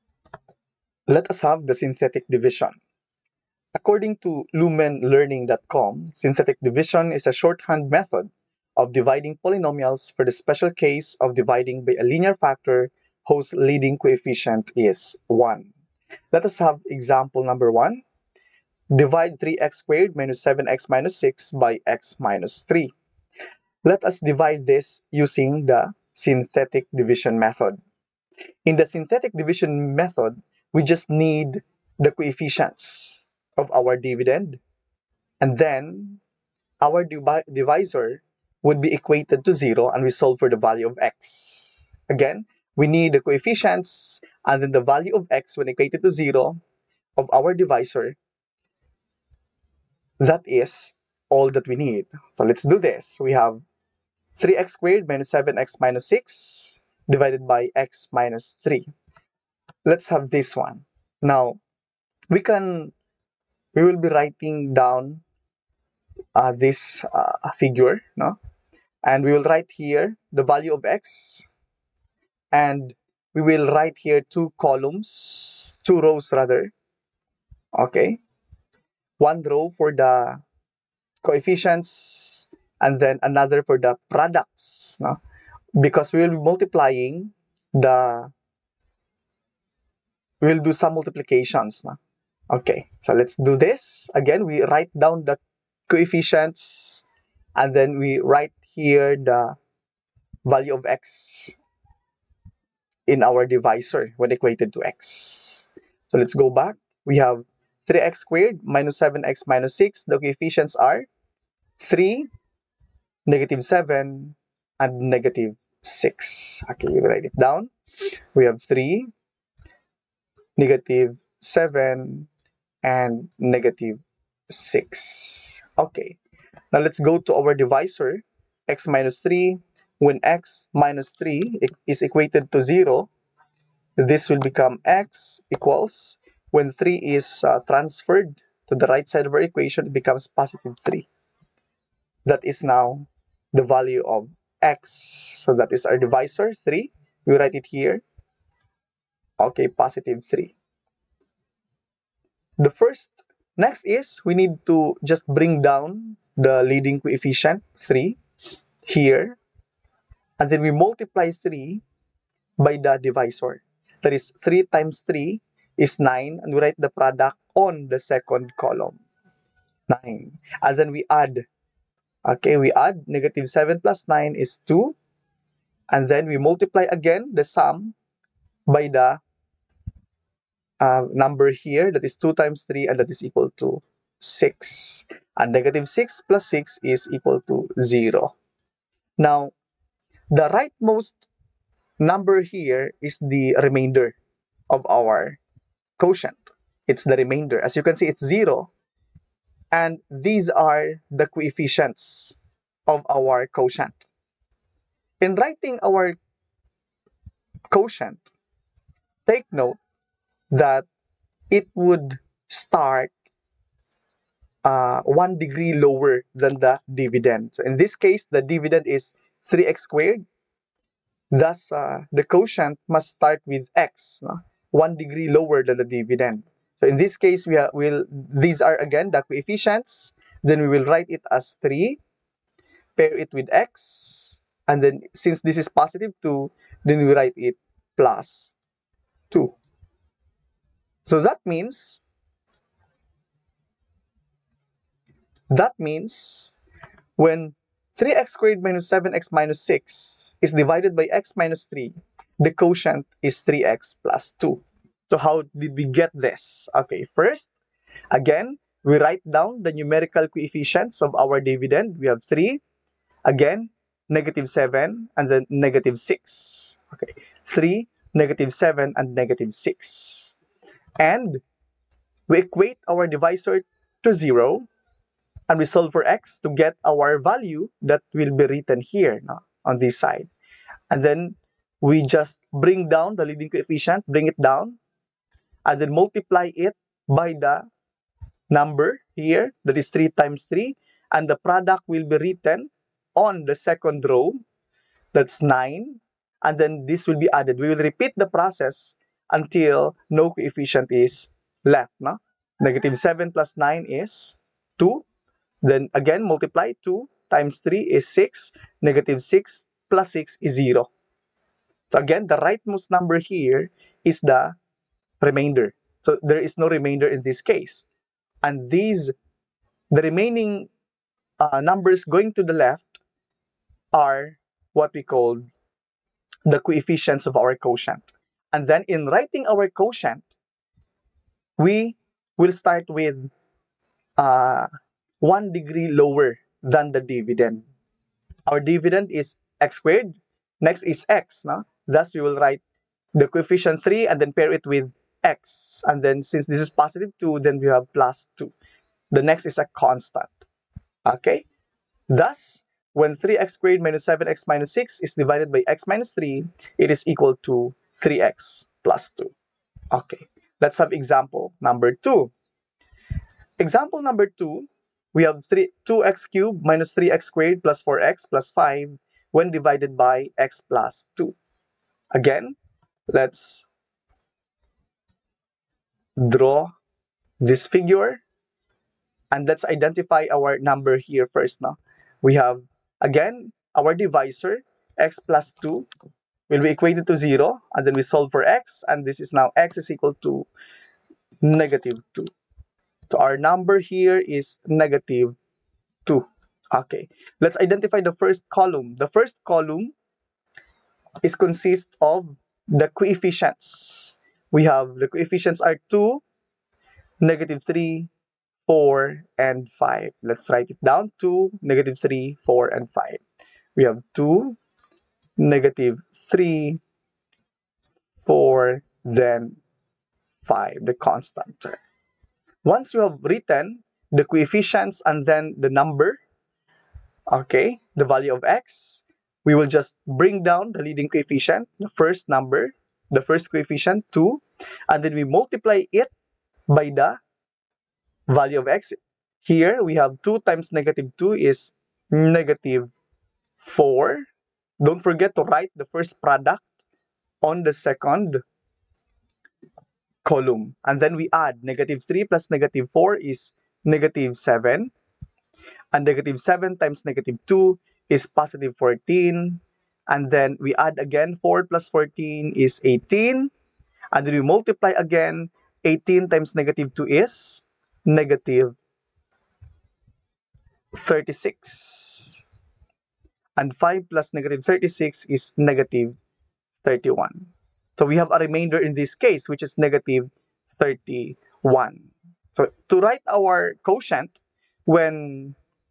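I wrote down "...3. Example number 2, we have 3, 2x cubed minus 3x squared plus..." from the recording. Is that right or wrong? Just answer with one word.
wrong.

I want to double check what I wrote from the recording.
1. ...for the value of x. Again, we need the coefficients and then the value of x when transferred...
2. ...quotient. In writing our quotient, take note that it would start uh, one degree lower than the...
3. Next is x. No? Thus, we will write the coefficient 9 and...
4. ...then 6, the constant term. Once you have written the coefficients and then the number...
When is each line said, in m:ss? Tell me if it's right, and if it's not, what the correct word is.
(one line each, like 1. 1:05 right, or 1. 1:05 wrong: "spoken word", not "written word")
1. 0:40 wrong: "equated", not "transferred"
2. 3:23 right
3. 5:40 wrong: "3", not "9"
4. 6:59 wrong: "5", not "6".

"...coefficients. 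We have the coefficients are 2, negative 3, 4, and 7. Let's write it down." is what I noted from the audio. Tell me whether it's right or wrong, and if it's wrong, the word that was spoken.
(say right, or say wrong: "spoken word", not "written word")
wrong: "5", not "7".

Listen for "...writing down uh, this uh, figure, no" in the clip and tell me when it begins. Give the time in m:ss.
1:04.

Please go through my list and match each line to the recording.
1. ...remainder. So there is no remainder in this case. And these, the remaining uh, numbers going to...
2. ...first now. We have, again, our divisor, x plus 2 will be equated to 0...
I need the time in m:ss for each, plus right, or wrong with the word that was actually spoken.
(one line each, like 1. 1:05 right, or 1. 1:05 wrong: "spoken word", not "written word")
1. 5:15 right
2. 6:21 right.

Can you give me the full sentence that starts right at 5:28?
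And then in writing our quotient, we will start with uh, one degree lower than the dividend.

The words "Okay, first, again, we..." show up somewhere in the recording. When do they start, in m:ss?
4:16.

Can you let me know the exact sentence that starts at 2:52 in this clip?
Okay, we add negative 7 plus 9 is 2.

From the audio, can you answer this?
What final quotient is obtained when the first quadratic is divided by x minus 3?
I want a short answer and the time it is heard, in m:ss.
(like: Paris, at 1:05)
3x + 2, at 4:12.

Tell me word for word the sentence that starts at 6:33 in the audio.
So our number here is negative 2.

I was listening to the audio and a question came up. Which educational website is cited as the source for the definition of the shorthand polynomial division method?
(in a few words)
lumenlearning.com.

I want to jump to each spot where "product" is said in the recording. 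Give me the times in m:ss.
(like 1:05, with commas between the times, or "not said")
1:24, 2:46, 4:51, 7:26.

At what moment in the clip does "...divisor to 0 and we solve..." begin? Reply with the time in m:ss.
4:33.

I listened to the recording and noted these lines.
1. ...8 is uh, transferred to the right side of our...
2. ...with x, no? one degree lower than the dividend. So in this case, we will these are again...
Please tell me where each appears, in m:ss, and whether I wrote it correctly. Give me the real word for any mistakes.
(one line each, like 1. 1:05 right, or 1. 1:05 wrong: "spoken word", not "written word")
1. 2:16 wrong: "3", not "8"
2. 3:43 right.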